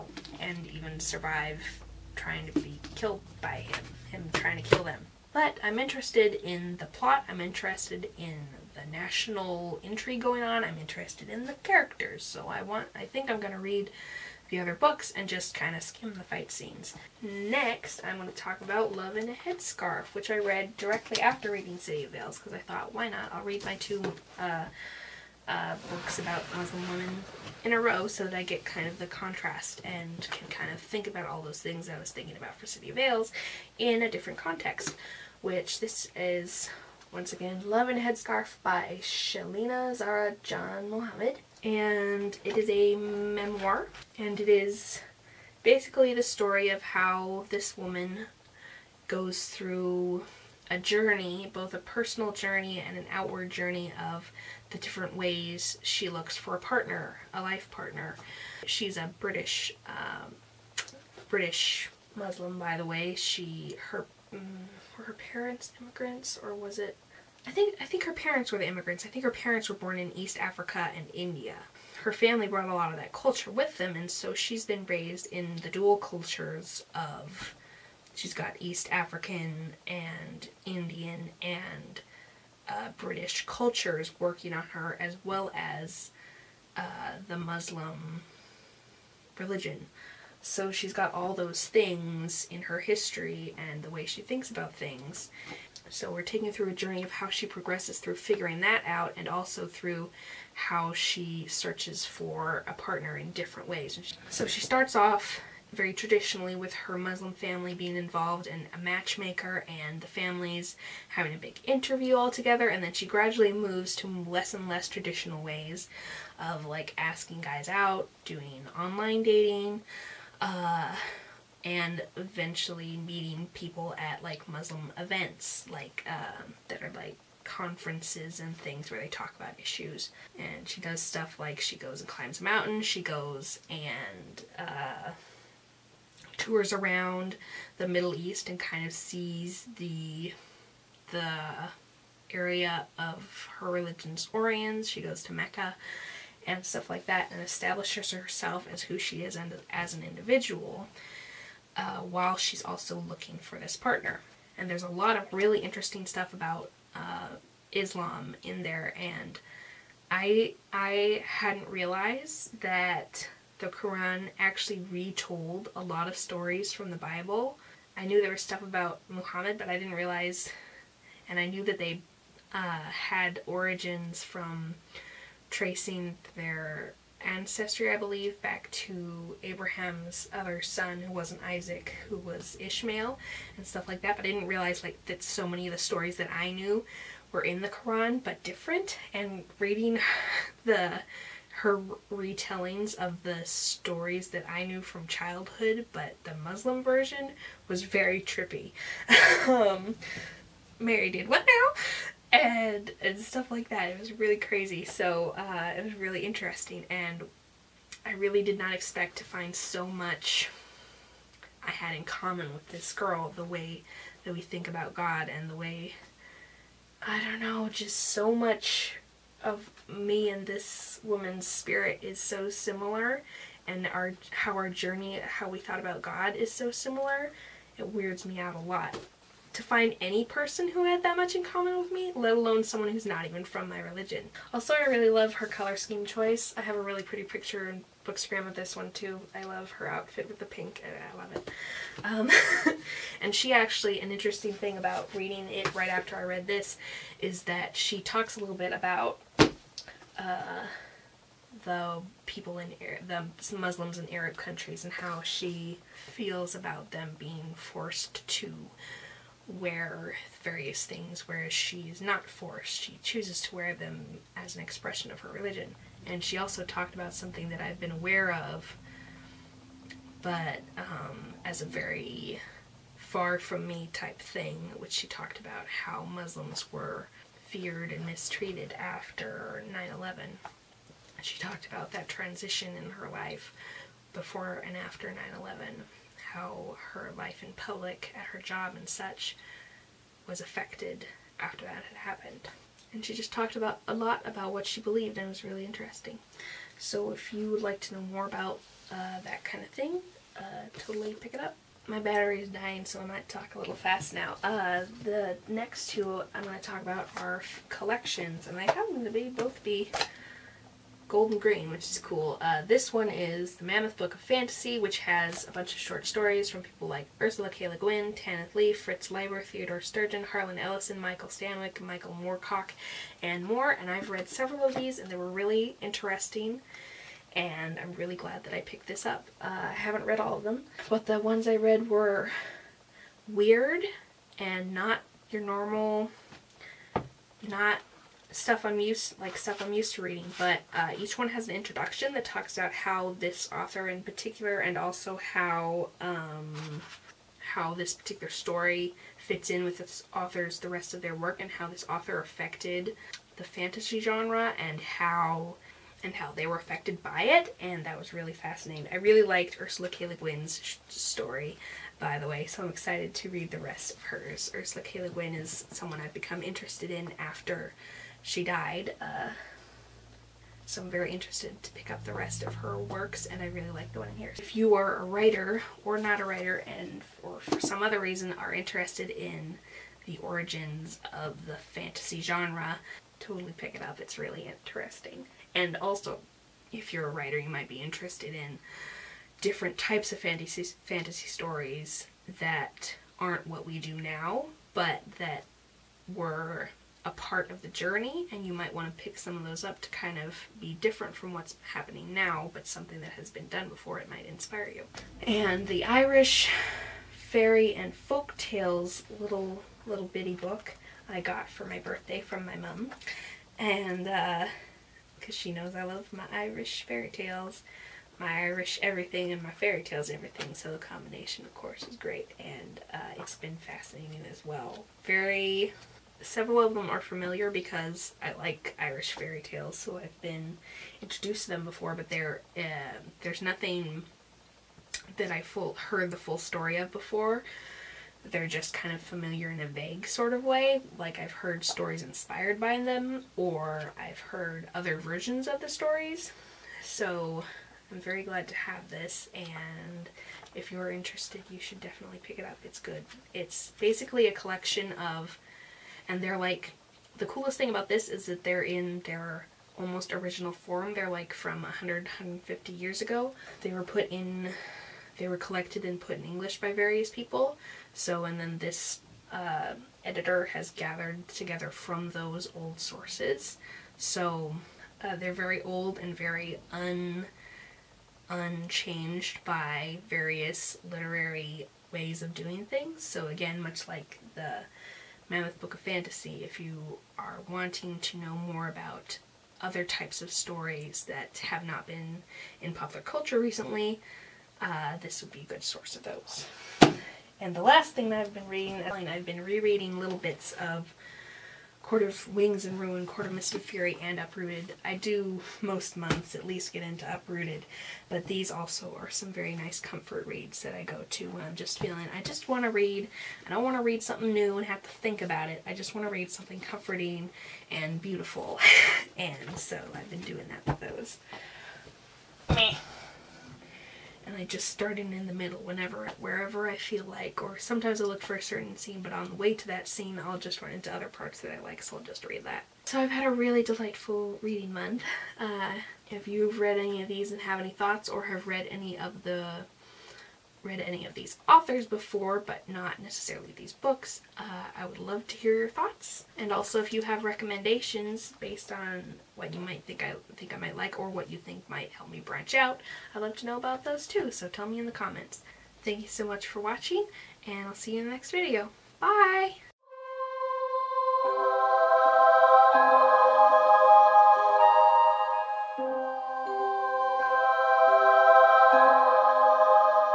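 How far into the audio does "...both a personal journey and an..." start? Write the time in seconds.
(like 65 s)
51 s.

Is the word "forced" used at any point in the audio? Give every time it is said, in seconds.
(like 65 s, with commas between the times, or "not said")
257 s, 262 s.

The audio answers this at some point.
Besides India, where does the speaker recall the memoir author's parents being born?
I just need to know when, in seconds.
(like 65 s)
70 s.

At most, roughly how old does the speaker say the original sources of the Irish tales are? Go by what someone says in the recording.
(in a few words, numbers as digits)
150 years.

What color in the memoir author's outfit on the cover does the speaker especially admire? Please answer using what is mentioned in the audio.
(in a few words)
Pink.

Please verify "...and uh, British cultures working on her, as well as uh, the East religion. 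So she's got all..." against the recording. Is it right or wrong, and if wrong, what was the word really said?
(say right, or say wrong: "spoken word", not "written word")
wrong: "Muslim", not "East".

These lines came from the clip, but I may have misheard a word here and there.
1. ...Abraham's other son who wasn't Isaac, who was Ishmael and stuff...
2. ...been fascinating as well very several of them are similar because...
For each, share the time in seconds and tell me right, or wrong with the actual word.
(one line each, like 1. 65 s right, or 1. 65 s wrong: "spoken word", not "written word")
1. 179 s right
2. 423 s wrong: "familiar", not "similar".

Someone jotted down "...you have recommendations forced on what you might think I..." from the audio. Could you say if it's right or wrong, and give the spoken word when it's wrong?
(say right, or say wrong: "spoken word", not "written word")
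wrong: "based", not "forced".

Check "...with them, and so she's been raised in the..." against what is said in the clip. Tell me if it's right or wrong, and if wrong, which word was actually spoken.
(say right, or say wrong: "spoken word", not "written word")
right.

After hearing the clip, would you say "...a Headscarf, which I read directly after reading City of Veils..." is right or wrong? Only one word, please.
right.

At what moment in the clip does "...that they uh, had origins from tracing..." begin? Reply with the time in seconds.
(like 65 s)
171 s.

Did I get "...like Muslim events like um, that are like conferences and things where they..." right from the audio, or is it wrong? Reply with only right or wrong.
right.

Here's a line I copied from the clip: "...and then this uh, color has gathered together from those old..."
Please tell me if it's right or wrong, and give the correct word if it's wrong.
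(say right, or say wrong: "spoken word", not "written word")
wrong: "editor", not "color".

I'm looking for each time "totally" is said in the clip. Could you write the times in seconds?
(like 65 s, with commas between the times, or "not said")
300 s, 383 s.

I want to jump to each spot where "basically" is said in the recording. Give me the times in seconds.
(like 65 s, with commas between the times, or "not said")
45 s, 453 s.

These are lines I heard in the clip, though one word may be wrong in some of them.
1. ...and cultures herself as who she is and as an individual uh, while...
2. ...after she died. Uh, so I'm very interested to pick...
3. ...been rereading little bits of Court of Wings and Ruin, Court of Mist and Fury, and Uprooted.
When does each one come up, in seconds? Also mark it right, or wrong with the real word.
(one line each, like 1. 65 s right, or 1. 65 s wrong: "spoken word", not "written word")
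1. 147 s wrong: "establishes", not "cultures"
2. 367 s right
3. 499 s right.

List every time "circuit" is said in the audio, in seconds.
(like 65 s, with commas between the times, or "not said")
not said.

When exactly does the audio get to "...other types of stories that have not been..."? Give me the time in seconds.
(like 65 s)
489 s.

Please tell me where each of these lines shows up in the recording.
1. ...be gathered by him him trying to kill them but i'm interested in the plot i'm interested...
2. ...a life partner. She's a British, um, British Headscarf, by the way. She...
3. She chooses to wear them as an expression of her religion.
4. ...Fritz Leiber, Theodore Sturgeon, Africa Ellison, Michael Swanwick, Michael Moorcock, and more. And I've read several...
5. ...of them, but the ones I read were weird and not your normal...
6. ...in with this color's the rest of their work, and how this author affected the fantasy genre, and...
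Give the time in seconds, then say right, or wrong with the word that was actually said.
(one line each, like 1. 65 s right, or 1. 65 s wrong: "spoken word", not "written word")
1. 2 s wrong: "killed", not "gathered"
2. 57 s wrong: "Muslim", not "Headscarf"
3. 262 s right
4. 318 s wrong: "Harlan", not "Africa"
5. 330 s right
6. 349 s wrong: "author", not "color".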